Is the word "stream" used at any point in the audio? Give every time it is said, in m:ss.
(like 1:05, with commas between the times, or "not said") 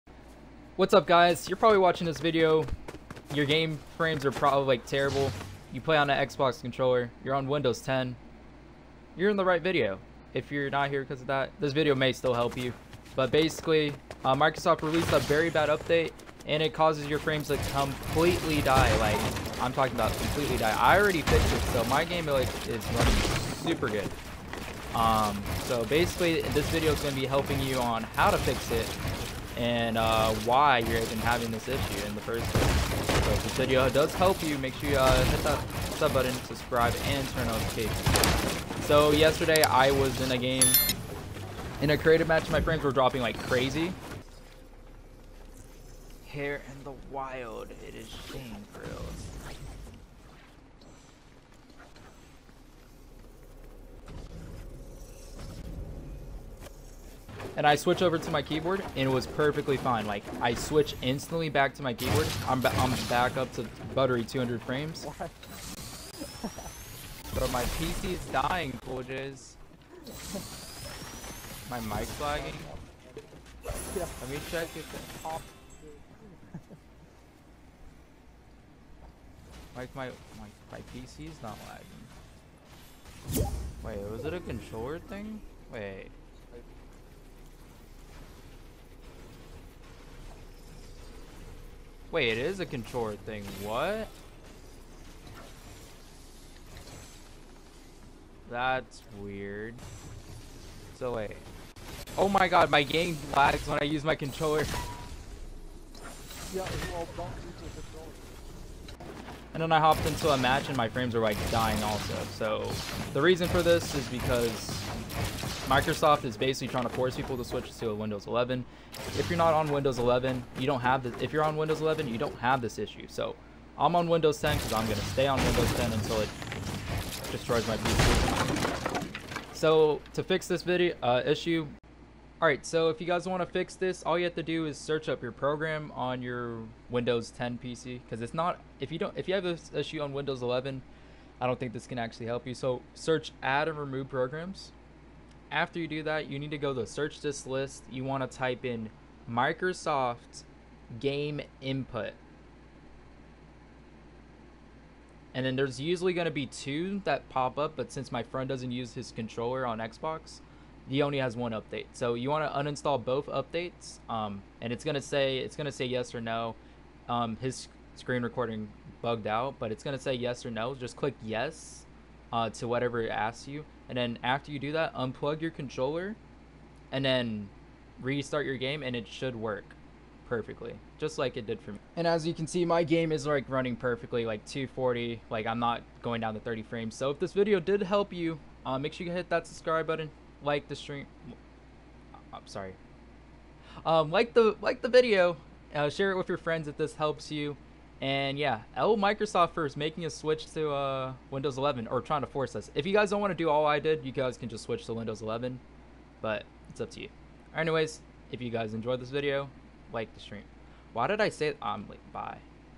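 3:10, 3:30.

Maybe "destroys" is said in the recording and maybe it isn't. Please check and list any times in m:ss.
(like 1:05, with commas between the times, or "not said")
2:07.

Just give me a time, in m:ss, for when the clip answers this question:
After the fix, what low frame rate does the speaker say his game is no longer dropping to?
3:06.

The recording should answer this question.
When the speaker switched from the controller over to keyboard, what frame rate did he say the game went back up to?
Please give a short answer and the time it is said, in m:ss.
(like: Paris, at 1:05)
200 frames, at 1:04.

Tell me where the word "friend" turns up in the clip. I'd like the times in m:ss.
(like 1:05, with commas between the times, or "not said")
2:38, 3:16.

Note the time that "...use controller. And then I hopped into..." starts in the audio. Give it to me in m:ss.
1:47.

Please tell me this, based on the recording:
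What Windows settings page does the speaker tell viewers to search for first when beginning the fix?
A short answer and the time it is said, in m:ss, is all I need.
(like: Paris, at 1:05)
add and remove programs, at 2:23.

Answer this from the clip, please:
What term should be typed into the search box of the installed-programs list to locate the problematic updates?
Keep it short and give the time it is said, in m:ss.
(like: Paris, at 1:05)
Microsoft game input, at 2:29.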